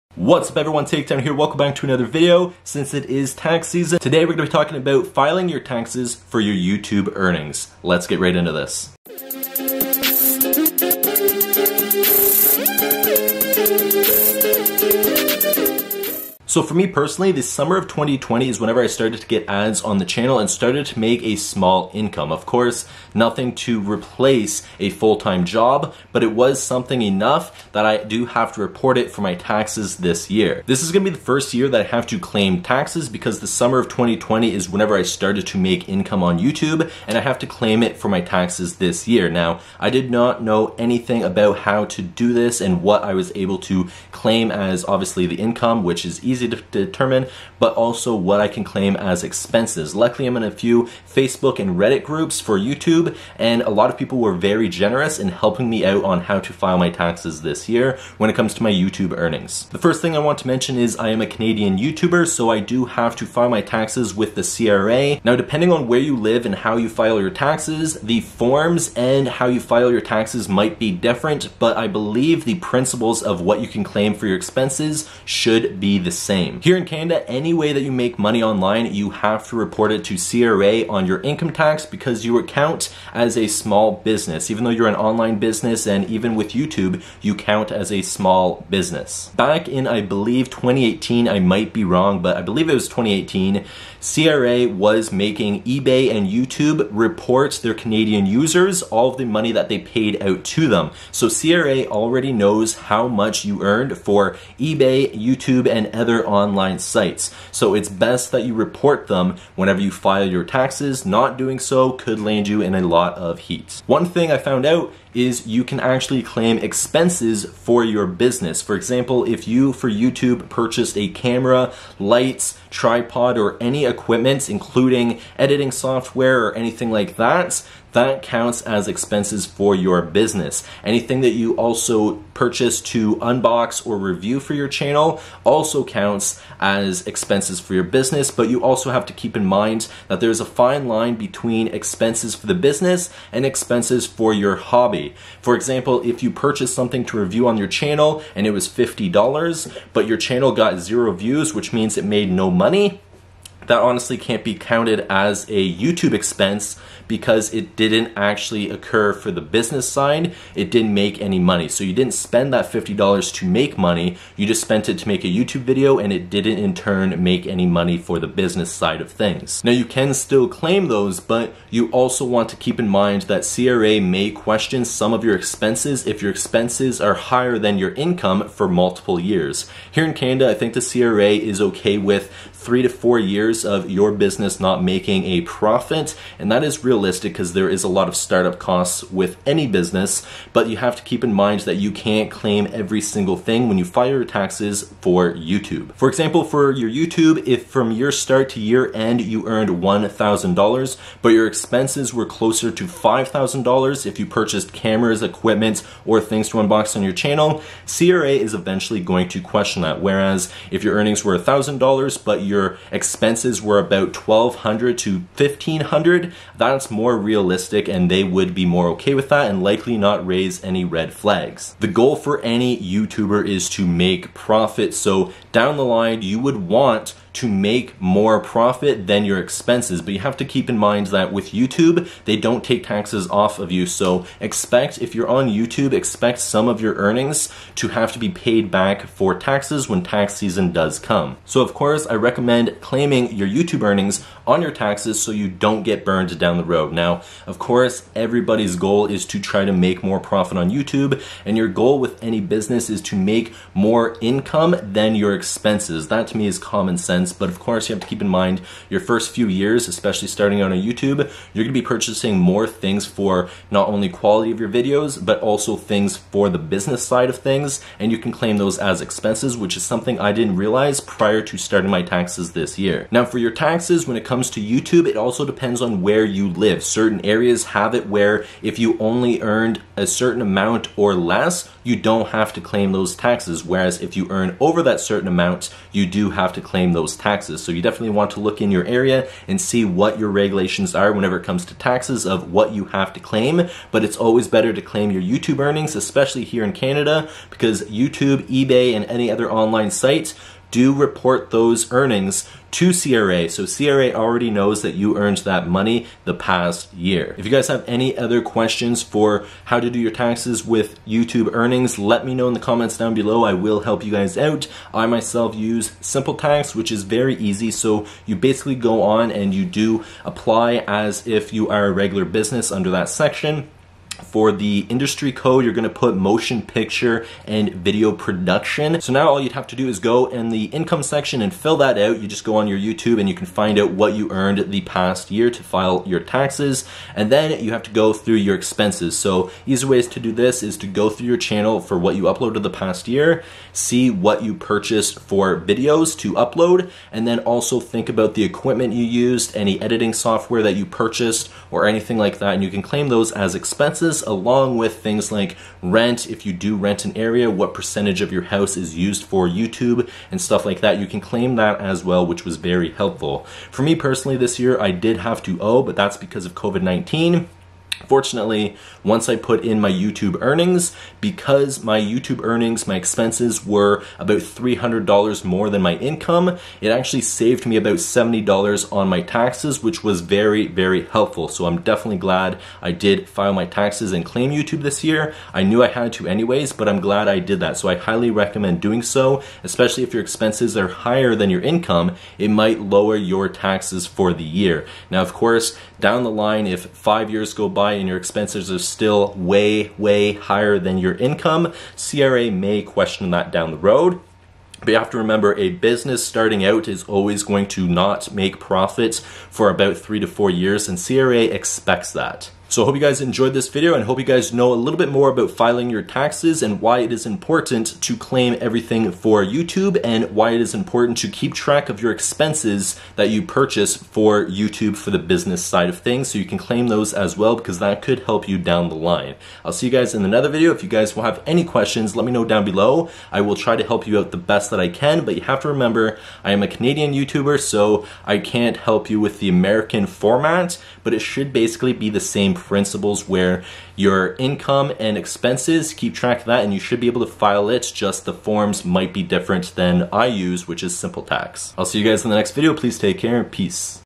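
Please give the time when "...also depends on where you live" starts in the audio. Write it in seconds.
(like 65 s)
275 s.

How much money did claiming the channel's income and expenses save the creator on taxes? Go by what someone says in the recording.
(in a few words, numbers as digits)
$70.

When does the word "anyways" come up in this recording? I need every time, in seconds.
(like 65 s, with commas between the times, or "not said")
386 s.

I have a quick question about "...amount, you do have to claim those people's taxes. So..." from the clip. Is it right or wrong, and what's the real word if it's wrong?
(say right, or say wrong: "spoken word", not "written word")
right.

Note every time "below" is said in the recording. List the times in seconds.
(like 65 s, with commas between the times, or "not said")
313 s, 432 s.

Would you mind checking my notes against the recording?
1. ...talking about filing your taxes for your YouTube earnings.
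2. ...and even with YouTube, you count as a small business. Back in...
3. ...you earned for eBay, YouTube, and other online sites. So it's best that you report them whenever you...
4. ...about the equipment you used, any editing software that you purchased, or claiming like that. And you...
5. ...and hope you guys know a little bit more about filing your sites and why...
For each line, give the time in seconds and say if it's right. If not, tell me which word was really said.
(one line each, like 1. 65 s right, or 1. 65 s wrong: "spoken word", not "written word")
1. 4 s right
2. 85 s right
3. 103 s right
4. 348 s wrong: "anything", not "claiming"
5. 413 s wrong: "taxes", not "sites".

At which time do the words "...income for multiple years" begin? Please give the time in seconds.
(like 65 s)
177 s.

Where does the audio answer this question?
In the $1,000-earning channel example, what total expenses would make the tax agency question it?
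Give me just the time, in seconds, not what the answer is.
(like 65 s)
202 s.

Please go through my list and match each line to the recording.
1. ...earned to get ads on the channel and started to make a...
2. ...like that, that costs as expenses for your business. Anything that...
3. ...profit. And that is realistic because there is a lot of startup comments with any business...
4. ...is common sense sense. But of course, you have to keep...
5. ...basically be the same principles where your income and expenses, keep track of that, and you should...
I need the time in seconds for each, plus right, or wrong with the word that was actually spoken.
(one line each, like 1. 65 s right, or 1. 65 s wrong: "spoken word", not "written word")
1. 18 s wrong: "started", not "earned"
2. 126 s wrong: "counts", not "costs"
3. 185 s wrong: "costs", not "comments"
4. 256 s right
5. 441 s right.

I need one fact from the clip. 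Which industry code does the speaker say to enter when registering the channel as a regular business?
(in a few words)
motion picture and video production.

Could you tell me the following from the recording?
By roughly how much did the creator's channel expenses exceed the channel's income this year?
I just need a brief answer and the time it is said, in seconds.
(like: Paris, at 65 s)
$300, at 374 s.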